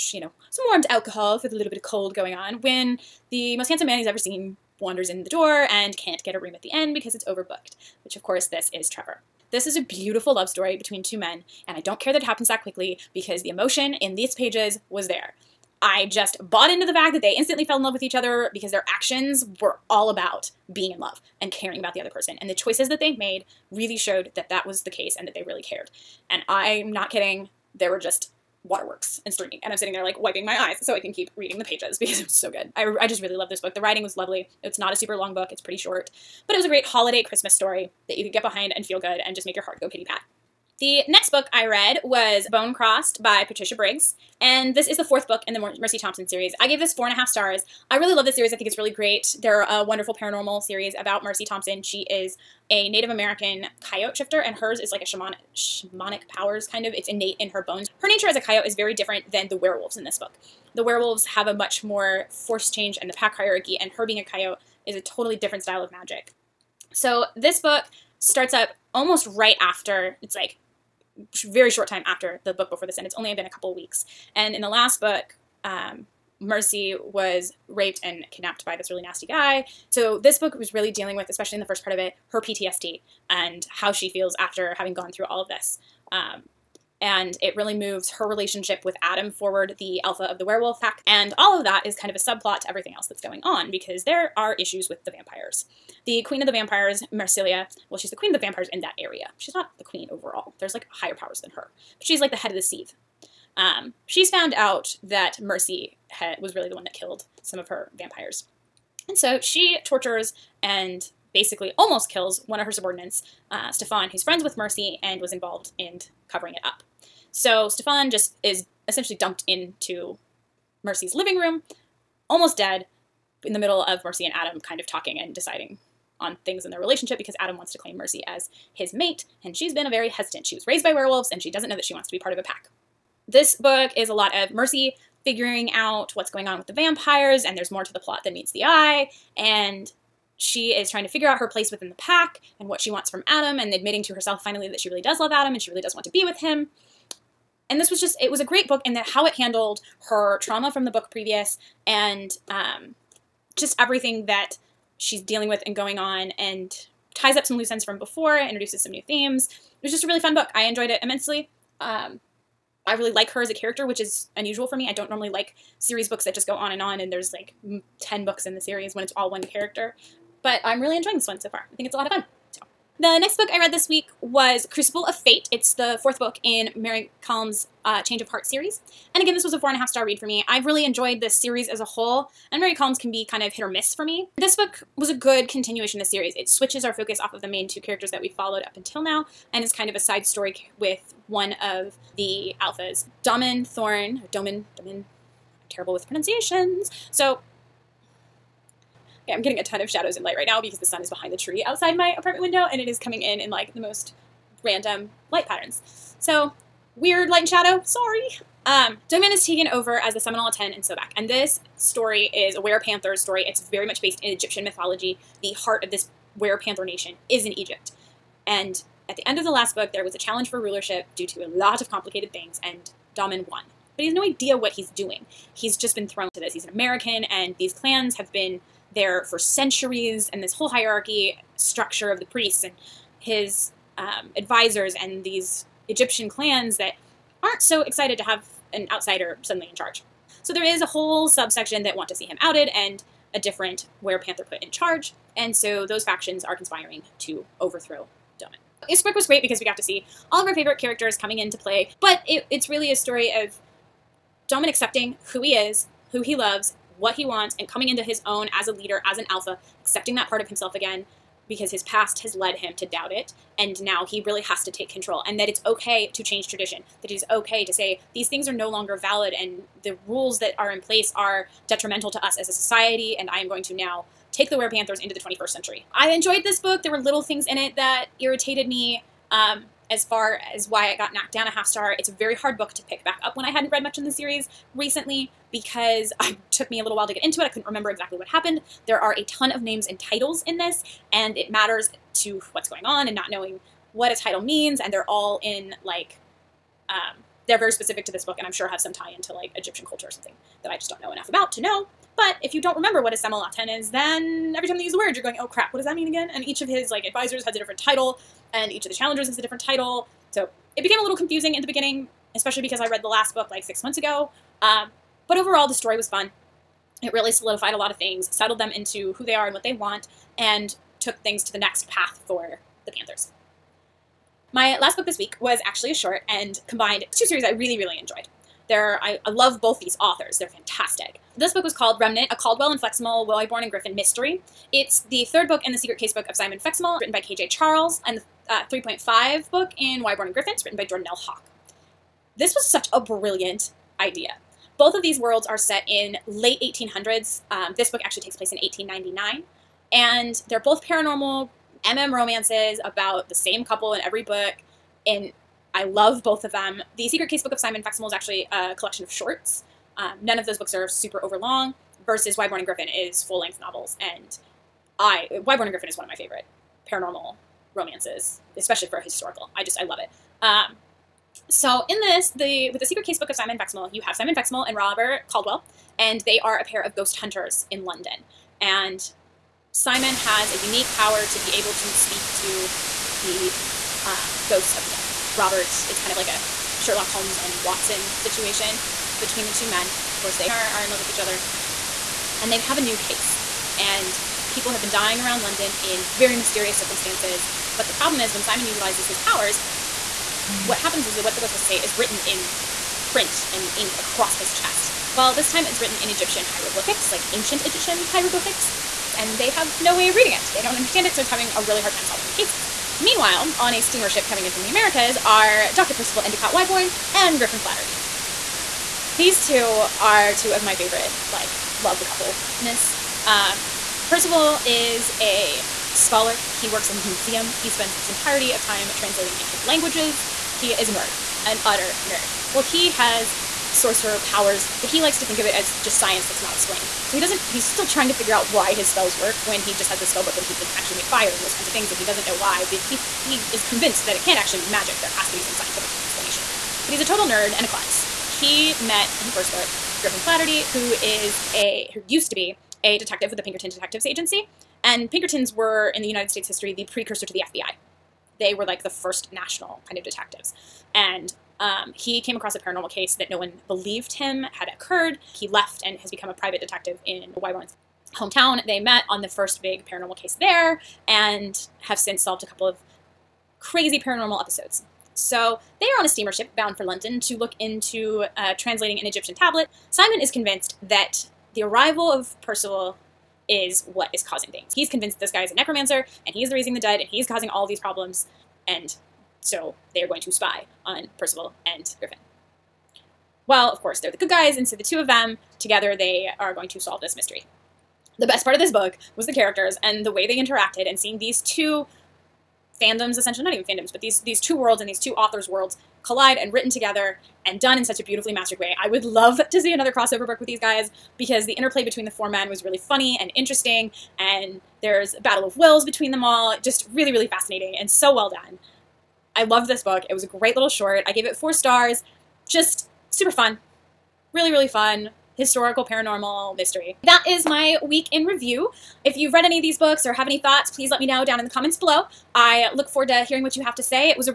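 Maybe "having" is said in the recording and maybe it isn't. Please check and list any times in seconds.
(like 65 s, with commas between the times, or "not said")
84 s, 411 s.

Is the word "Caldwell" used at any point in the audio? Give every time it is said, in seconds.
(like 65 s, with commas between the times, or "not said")
332 s, 375 s.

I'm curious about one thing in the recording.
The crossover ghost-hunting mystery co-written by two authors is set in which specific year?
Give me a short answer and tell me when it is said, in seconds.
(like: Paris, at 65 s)
1899, at 348 s.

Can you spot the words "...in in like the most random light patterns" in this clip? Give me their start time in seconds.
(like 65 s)
203 s.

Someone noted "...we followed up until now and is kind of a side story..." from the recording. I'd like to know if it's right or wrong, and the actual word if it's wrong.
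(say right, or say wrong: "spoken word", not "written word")
right.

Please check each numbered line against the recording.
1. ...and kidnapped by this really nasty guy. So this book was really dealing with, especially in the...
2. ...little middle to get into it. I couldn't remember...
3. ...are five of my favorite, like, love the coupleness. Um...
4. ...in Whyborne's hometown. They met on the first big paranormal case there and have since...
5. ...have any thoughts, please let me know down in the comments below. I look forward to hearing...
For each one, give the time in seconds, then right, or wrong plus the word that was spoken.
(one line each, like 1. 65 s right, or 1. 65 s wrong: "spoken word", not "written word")
1. 78 s right
2. 286 s wrong: "while", not "middle"
3. 419 s wrong: "two", not "five"
4. 467 s right
5. 530 s right.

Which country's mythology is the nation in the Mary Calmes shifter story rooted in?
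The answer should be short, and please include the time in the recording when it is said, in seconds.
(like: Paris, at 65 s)
Egypt, at 217 s.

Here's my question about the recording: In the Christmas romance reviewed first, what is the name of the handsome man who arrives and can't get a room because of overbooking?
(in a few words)
Trevor.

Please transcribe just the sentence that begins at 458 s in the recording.
They were like the first national kind of detectives.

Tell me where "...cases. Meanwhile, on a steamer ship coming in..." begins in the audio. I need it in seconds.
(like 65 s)
412 s.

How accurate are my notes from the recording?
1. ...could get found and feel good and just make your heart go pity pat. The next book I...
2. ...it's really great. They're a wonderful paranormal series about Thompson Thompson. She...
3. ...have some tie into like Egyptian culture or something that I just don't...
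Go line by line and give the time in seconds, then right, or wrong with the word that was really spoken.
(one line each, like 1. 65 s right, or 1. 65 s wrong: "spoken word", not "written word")
1. 38 s wrong: "behind", not "found"
2. 48 s wrong: "Mercy", not "Thompson"
3. 298 s right.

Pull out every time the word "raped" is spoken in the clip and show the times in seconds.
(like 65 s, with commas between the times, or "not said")
77 s.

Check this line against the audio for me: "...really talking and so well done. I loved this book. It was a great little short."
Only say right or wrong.
wrong.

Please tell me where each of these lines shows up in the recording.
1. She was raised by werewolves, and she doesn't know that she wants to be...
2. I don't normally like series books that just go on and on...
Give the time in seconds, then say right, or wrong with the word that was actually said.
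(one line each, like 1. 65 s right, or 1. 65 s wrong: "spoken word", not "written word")
1. 130 s right
2. 164 s right.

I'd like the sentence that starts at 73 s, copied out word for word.
It's only been a couple weeks.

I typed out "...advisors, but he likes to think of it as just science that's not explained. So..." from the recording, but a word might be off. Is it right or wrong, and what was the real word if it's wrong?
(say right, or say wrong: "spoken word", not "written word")
wrong: "powers", not "advisors".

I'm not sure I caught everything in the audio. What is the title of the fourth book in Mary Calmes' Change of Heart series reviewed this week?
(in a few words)
Crucible of Fate.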